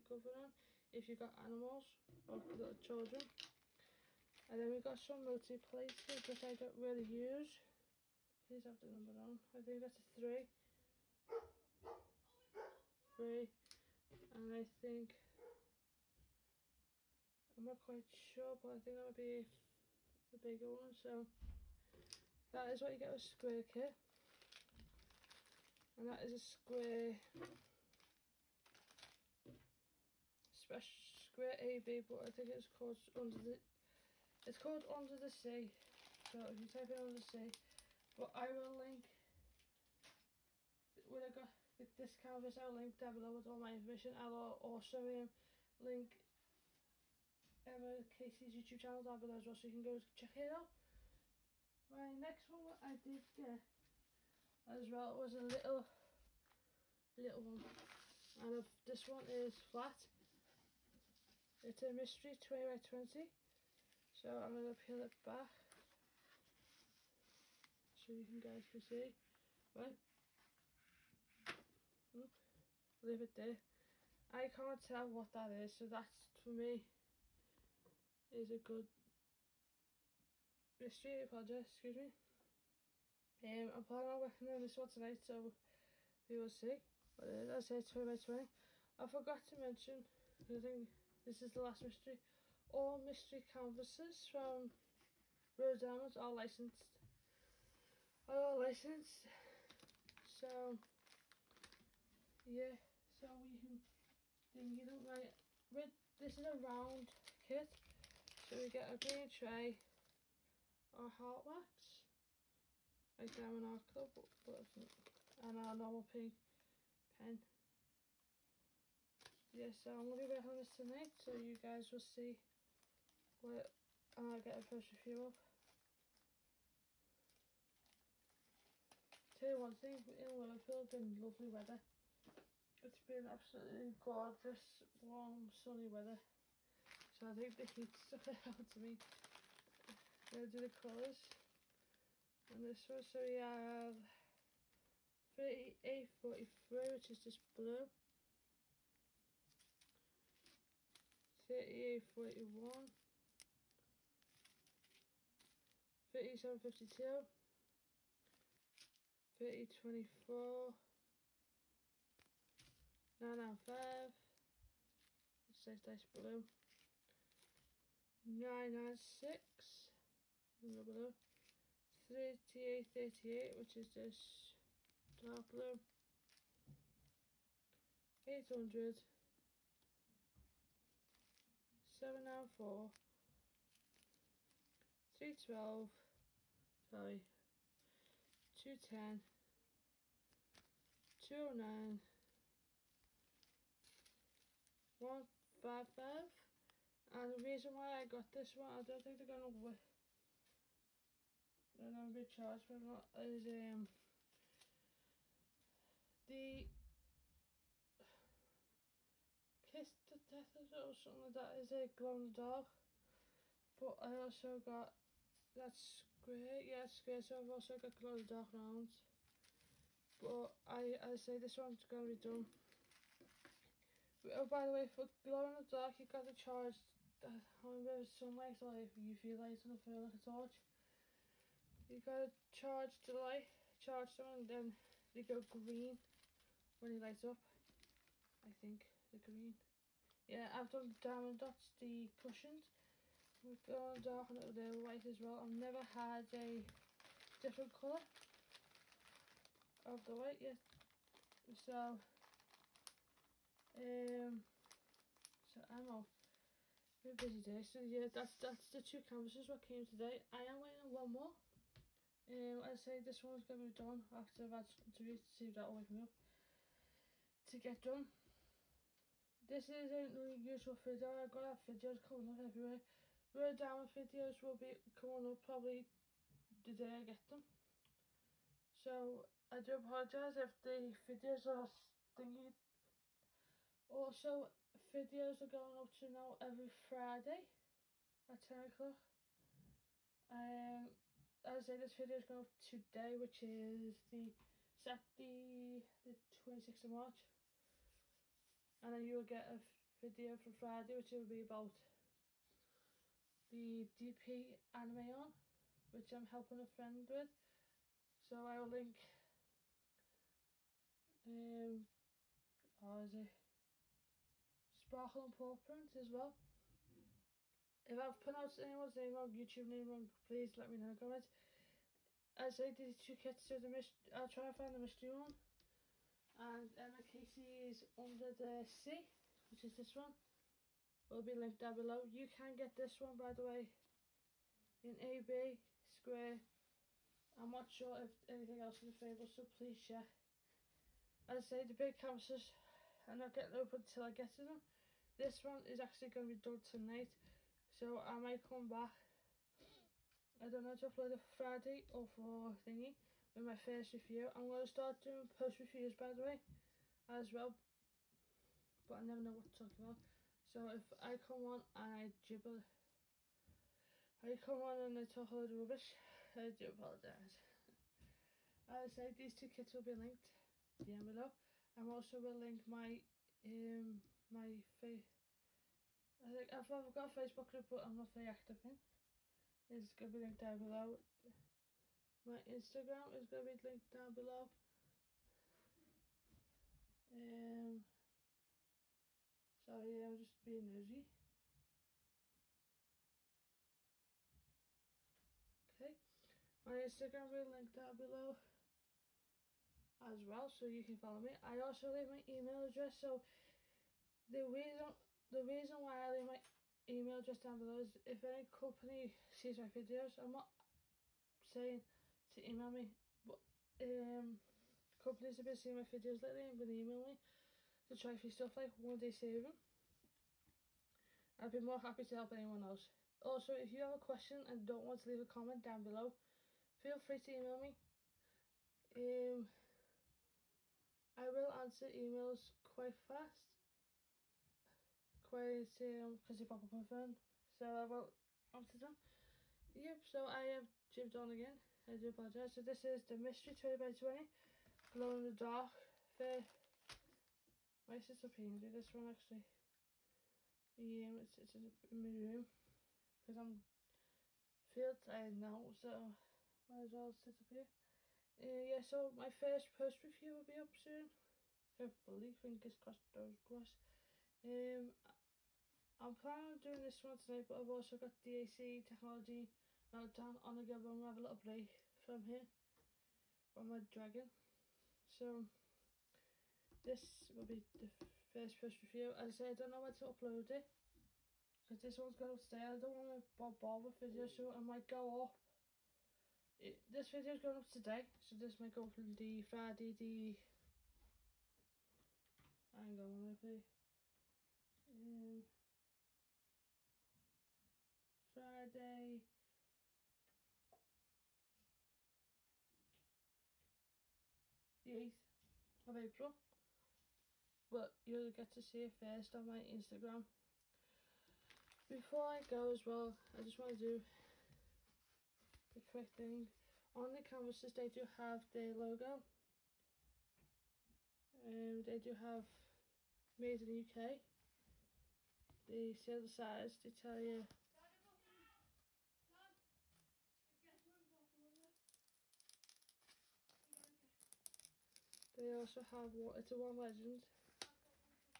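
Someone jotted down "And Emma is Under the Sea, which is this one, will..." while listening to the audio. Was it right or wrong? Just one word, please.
right.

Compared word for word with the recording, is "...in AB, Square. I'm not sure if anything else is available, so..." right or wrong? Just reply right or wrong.
right.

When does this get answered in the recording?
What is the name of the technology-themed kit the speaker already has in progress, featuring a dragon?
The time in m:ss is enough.
7:49.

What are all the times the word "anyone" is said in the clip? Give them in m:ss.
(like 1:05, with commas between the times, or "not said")
5:18, 7:02.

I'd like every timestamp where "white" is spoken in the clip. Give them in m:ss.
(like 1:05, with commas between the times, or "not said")
4:04, 4:10.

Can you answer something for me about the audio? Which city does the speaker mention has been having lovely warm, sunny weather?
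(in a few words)
Liverpool.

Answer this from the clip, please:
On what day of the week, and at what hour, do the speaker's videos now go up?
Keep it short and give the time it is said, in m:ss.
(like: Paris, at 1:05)
Friday at 10 o'clock, at 4:46.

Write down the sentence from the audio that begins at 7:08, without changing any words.
Um, I will answer emails quite fast quiz um because you popped up on my phone.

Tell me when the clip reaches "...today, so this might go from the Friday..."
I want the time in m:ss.
8:07.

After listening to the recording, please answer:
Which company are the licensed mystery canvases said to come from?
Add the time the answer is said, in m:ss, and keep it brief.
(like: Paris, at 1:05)
Rowe Diamonds, at 1:35.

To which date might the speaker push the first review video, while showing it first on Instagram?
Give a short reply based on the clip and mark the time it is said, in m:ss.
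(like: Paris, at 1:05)
Friday 8th April, at 8:18.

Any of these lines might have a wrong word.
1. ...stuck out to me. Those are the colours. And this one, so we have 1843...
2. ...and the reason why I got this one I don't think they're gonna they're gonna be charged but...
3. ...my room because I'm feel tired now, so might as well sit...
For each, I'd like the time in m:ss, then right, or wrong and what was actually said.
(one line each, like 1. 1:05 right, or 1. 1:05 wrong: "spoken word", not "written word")
1. 2:17 wrong: "3843", not "1843"
2. 3:17 right
3. 7:31 right.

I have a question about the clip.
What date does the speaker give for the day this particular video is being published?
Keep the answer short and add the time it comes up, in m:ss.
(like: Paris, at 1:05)
Saturday 26th March, at 4:54.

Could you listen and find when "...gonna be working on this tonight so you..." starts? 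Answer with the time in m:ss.
2:00.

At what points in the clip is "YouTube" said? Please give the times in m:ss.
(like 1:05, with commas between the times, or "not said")
0:48, 5:19.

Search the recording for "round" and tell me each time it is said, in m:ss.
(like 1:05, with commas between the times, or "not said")
1:46, 3:38.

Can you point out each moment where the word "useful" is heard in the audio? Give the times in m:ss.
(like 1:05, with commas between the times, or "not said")
4:30.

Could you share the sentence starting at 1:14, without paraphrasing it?
I can't tell what that is, so that's for me is a good mystery project, excuse me.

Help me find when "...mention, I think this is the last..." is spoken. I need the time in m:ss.
1:29.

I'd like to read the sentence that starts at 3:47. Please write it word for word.
I remember sunlight like UV light gonna phone like a torch.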